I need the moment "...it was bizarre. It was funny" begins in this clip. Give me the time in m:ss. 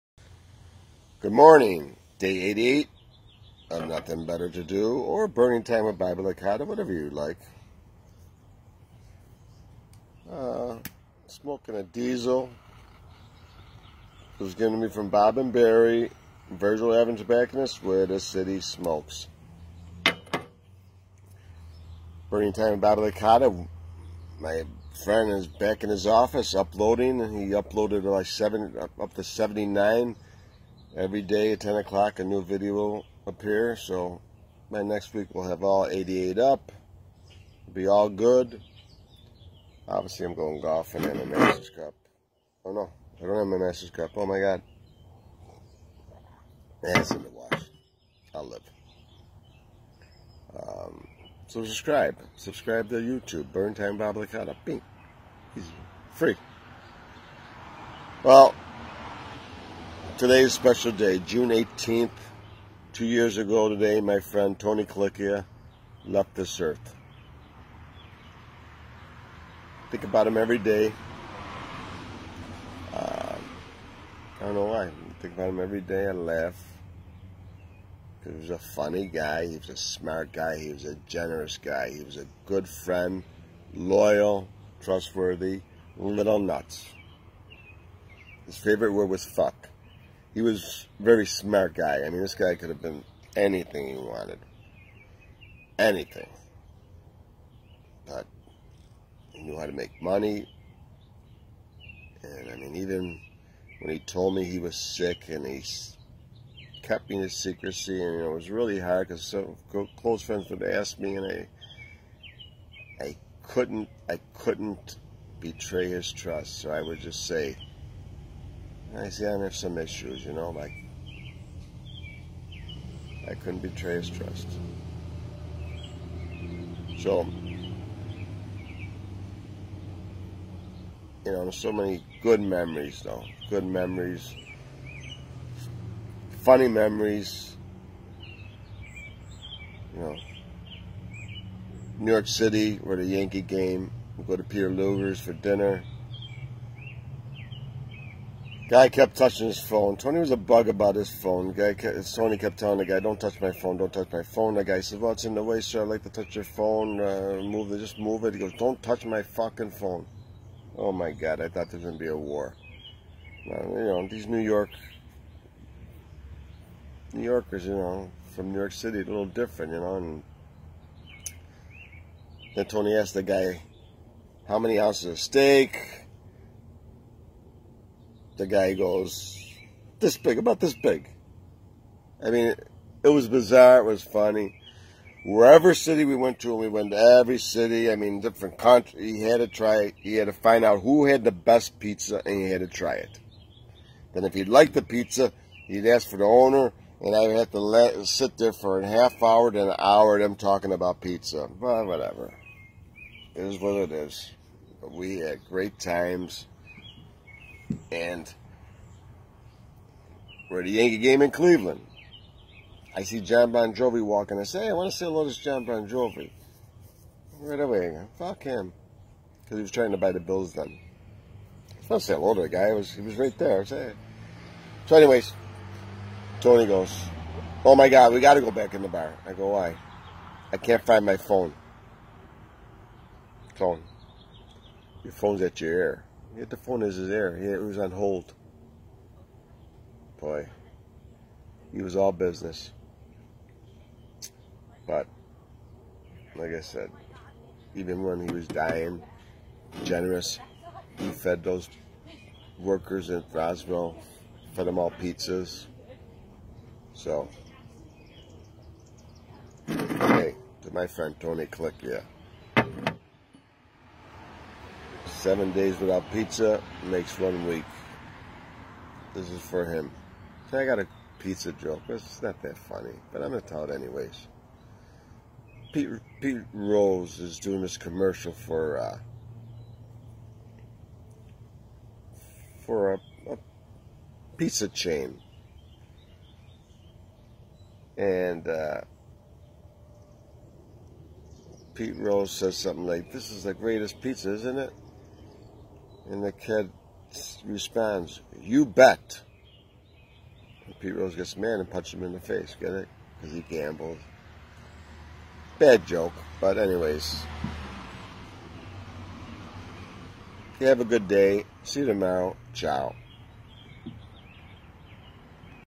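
3:03.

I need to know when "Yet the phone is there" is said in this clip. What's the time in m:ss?
3:56.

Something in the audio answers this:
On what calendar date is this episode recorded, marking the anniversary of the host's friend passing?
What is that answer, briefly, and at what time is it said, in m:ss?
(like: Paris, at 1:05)
June 18th, at 1:01.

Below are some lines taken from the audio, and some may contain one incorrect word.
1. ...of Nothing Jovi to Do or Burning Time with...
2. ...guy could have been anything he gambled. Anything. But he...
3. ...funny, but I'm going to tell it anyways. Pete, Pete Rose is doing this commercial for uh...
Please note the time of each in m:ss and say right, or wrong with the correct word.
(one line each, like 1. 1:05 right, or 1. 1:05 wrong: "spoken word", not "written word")
1. 0:03 wrong: "Better", not "Jovi"
2. 1:32 wrong: "wanted", not "gambled"
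3. 4:32 right.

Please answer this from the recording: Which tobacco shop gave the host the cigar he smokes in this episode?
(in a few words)
Virgil Evans Tobacconist.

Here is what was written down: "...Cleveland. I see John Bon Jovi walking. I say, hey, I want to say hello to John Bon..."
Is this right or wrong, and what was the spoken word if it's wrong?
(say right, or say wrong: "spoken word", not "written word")
right.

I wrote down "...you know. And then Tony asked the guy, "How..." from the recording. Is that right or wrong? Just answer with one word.
right.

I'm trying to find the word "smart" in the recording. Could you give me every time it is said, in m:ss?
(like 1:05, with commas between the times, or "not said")
1:19, 1:31.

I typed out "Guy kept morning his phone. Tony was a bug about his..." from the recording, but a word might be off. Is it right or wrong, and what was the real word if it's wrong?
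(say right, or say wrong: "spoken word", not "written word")
wrong: "touching", not "morning".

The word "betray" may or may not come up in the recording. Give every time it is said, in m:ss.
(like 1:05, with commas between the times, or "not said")
1:55, 2:03.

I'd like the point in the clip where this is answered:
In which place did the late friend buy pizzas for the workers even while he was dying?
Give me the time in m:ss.
4:13.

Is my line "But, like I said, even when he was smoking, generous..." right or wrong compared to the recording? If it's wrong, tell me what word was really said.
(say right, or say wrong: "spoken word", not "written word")
wrong: "dying", not "smoking".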